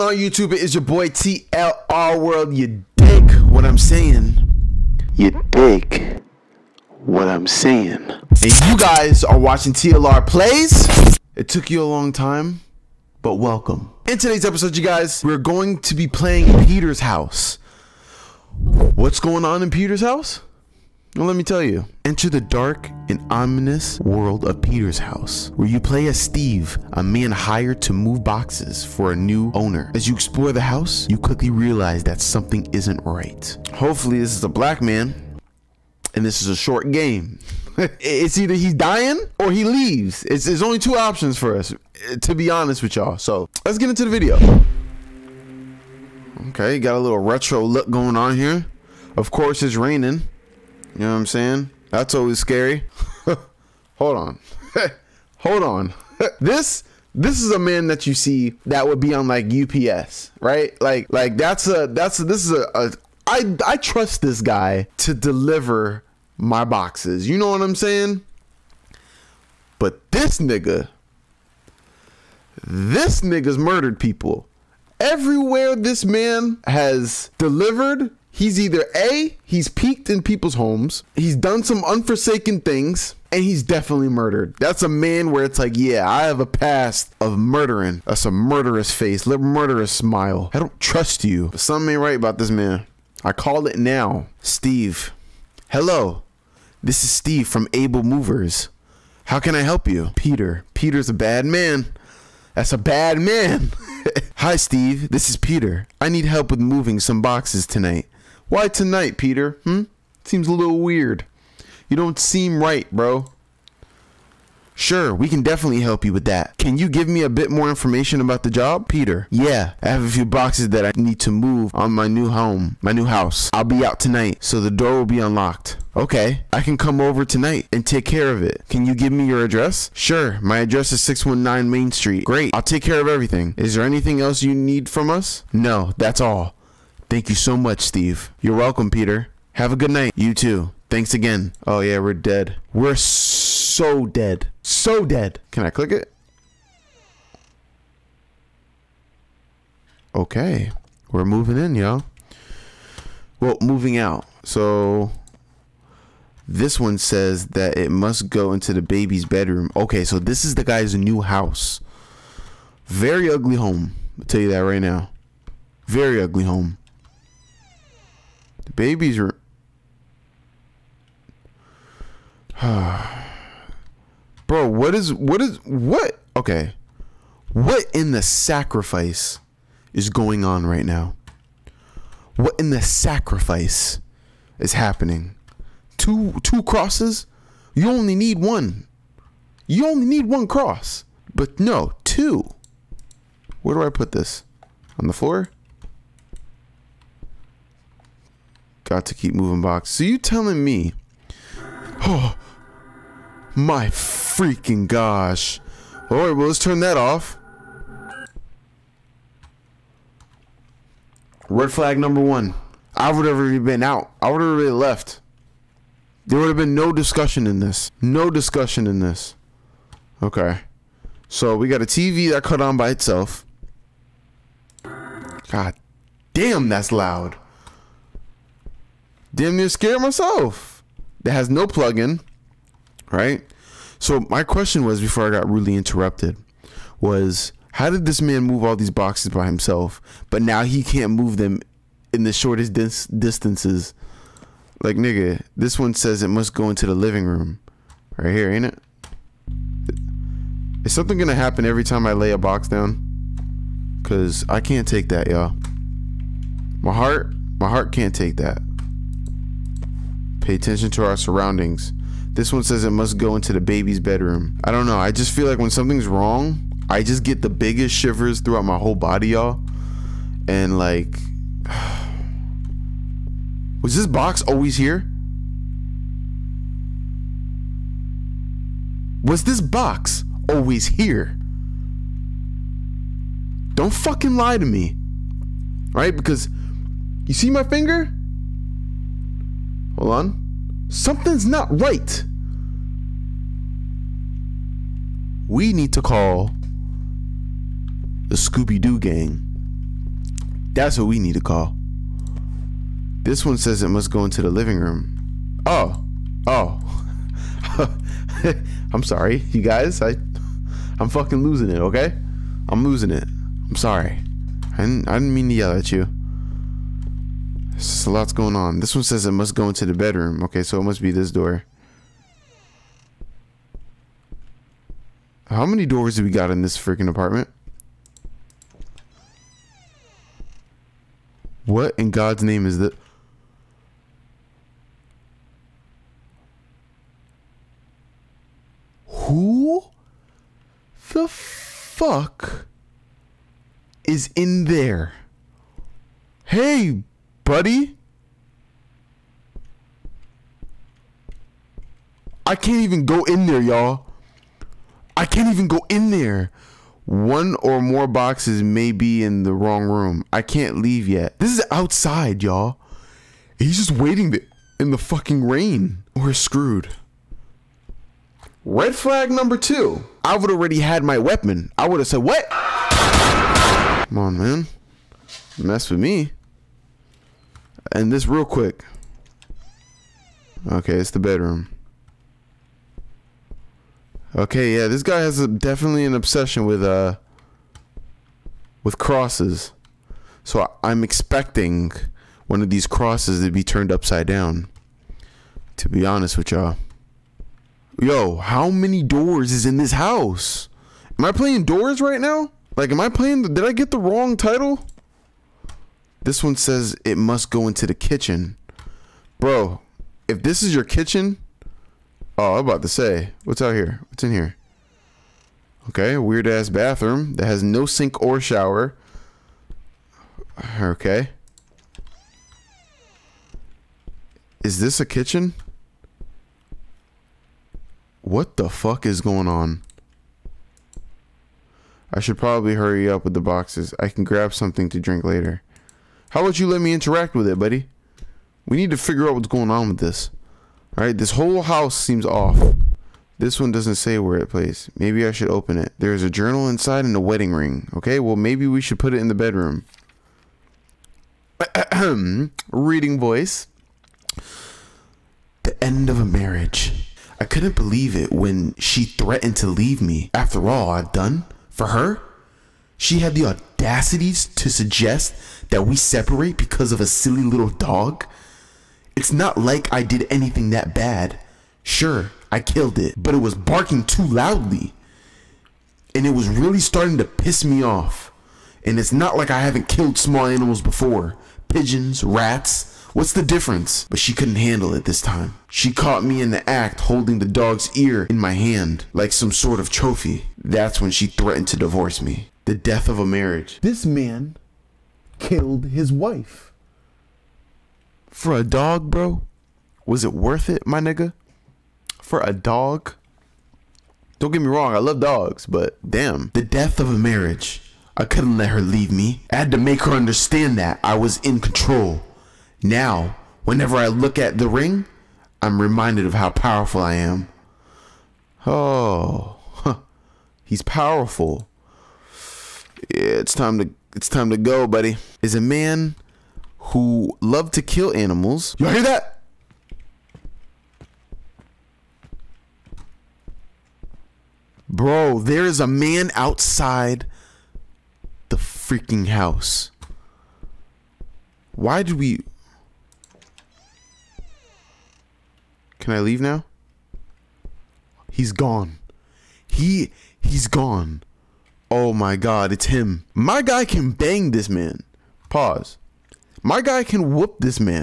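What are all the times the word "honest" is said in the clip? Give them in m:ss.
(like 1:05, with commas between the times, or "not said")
0:42, 6:36.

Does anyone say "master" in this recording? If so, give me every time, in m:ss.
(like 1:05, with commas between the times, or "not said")
not said.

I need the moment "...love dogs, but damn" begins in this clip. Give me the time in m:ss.
8:24.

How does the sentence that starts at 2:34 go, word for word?
So this one says that it must go into the baby's bedroom.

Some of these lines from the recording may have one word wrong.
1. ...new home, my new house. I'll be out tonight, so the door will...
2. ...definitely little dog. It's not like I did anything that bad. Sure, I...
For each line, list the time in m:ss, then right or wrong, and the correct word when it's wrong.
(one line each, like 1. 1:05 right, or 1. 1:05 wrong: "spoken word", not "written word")
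1. 2:02 right
2. 7:47 wrong: "silly", not "definitely".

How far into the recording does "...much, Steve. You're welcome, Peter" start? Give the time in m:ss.
2:17.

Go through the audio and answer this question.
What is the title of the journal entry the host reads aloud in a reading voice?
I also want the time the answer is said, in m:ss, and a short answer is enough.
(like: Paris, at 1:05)
The end of a marriage, at 7:35.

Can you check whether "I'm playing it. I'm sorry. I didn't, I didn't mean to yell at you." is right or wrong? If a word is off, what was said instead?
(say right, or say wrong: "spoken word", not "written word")
wrong: "losing", not "playing".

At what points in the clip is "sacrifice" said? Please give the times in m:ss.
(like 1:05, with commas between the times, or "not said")
2:58, 3:02.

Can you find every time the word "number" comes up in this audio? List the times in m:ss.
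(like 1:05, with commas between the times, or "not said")
3:31, 6:09.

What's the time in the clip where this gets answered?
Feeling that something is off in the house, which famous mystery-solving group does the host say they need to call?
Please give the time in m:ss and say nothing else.
4:58.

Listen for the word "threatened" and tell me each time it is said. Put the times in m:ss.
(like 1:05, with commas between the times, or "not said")
7:39, 8:11.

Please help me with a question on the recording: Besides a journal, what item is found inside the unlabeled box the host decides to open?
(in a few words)
Wedding ring.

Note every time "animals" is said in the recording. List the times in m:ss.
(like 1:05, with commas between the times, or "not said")
8:00, 8:48.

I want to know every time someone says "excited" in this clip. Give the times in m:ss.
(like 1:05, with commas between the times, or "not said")
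not said.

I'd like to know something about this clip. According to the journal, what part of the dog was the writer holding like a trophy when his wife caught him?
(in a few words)
Ear.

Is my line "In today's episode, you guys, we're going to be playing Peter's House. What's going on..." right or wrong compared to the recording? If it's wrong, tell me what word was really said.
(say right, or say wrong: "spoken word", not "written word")
right.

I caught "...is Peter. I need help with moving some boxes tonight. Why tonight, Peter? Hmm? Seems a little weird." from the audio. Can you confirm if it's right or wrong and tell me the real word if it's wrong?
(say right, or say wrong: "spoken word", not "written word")
right.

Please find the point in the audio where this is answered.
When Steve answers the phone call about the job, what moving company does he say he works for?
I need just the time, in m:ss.
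1:37.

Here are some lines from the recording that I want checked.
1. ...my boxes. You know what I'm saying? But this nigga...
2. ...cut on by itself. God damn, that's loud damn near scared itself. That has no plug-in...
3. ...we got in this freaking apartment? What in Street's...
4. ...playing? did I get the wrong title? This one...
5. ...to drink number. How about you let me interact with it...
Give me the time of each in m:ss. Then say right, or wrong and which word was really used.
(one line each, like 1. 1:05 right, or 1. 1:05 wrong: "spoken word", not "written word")
1. 1:06 right
2. 3:42 wrong: "myself", not "itself"
3. 5:26 wrong: "God", not "Street"
4. 6:43 right
5. 7:14 wrong: "later", not "number".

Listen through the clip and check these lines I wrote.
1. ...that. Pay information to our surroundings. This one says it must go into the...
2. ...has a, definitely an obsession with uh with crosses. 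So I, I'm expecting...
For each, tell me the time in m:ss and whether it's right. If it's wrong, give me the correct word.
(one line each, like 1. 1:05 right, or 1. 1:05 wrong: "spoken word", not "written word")
1. 4:18 wrong: "attention", not "information"
2. 6:25 right.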